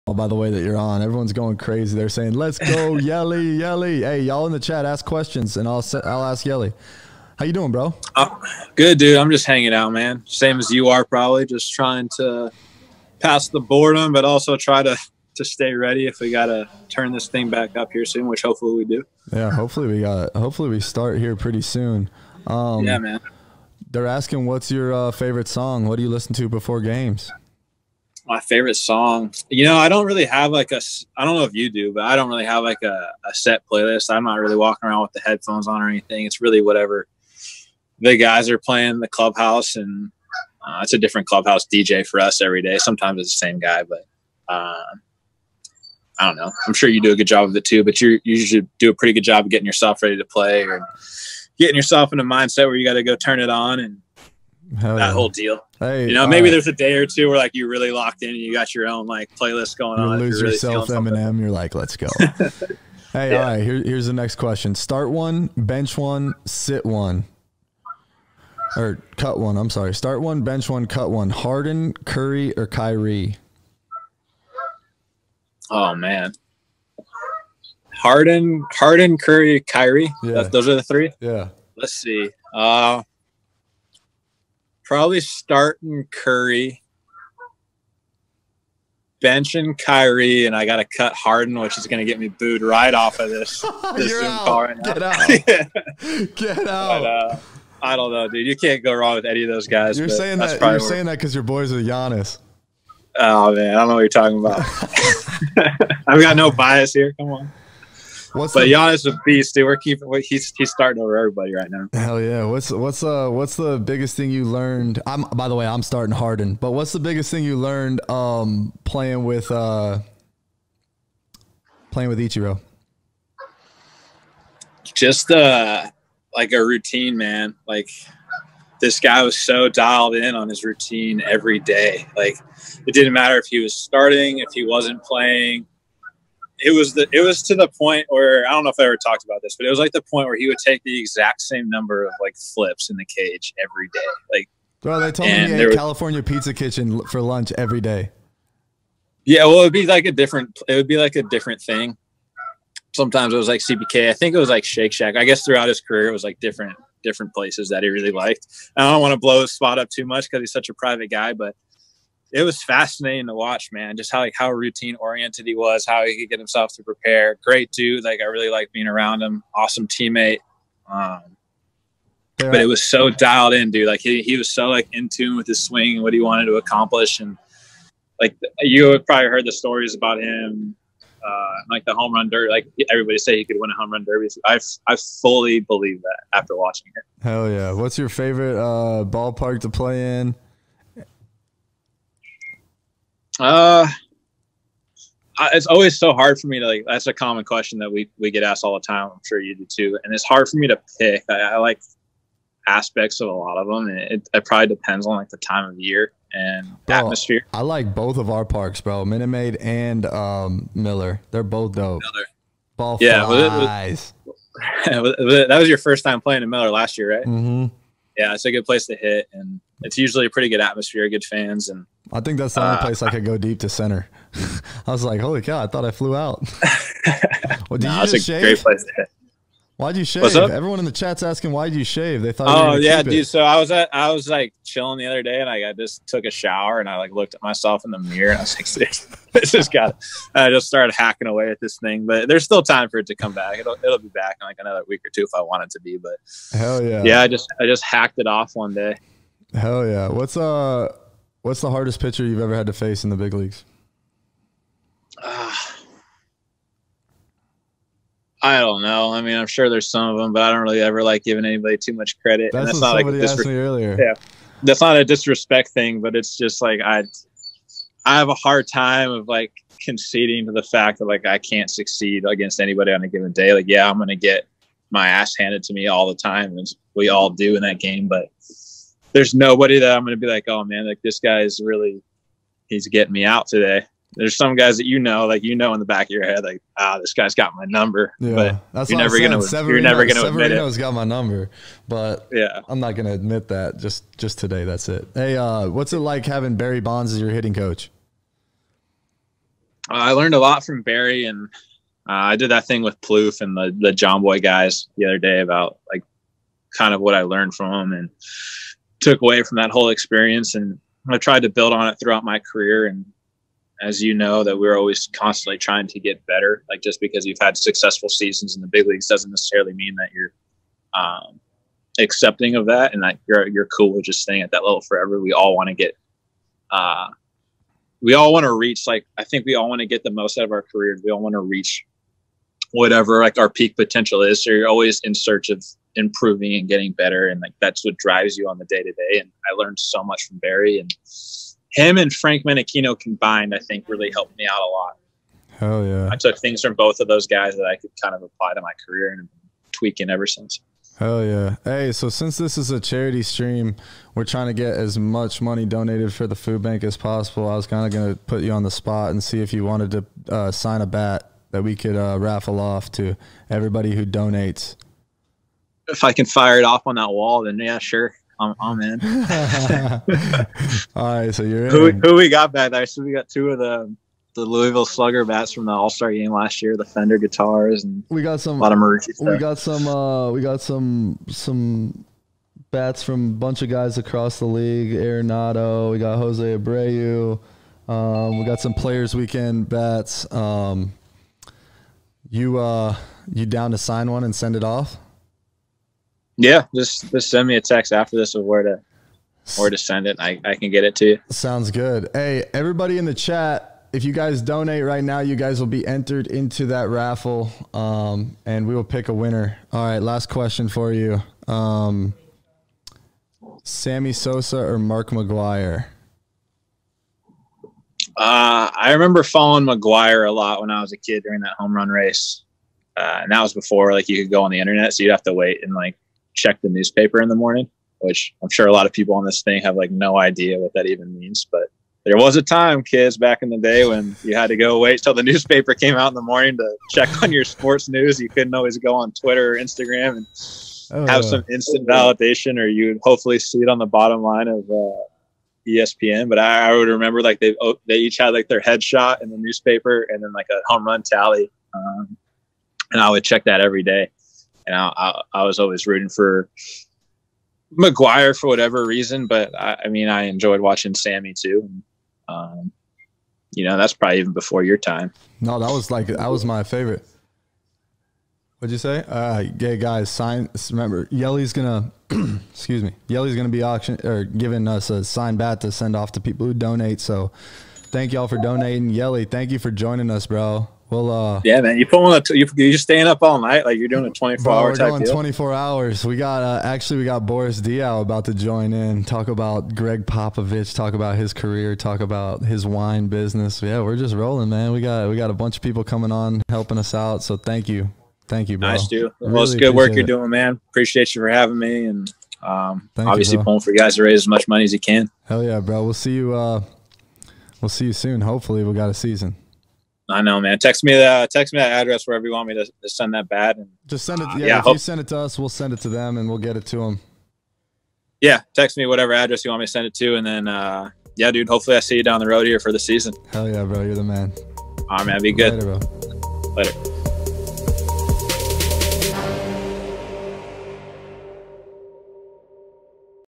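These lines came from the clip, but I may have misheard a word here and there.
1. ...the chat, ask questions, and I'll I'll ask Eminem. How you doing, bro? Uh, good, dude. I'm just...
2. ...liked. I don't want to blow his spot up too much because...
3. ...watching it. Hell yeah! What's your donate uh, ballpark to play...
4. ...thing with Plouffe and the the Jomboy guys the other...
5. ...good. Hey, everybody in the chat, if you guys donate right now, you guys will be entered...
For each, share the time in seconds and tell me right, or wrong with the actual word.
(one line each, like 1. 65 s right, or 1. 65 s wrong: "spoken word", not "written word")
1. 4 s wrong: "Yelly", not "Eminem"
2. 158 s right
3. 186 s wrong: "favorite", not "donate"
4. 302 s right
5. 401 s right.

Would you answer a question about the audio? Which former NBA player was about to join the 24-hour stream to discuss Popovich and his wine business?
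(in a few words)
Boris Diaw.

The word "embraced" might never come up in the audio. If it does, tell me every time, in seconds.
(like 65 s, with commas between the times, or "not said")
not said.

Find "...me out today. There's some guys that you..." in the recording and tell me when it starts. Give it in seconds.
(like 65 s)
283 s.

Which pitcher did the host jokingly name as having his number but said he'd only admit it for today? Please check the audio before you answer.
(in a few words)
Severino.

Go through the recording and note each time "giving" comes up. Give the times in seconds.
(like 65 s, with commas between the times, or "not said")
261 s, 474 s.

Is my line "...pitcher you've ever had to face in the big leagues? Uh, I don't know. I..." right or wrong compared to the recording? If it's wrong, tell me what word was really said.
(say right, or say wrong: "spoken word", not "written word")
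right.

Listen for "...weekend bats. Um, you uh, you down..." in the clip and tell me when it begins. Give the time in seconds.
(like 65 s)
389 s.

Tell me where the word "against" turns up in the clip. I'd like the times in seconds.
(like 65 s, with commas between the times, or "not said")
272 s.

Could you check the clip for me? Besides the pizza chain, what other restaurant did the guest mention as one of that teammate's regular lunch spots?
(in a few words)
Shake Shack.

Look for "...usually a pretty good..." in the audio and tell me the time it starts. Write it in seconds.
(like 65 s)
219 s.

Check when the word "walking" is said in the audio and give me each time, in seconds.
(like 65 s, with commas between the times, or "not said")
34 s.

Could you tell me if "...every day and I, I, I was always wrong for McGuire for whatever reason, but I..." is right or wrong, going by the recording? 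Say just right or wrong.
wrong.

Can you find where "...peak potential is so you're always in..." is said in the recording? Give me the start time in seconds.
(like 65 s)
333 s.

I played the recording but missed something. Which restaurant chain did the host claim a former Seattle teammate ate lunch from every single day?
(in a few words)
California Pizza Kitchen.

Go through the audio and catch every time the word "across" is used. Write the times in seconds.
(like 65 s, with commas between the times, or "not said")
383 s.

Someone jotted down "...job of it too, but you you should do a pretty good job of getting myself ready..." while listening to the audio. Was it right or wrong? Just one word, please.
wrong.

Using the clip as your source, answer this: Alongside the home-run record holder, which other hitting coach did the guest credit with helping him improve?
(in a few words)
Frank Menechino.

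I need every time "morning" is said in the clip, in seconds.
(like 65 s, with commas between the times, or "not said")
427 s, 436 s.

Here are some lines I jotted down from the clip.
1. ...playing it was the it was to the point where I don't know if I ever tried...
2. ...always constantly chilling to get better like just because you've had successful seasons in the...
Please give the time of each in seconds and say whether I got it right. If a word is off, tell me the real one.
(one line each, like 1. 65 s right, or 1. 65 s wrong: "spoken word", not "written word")
1. 135 s wrong: "talked", not "tried"
2. 314 s wrong: "trying", not "chilling".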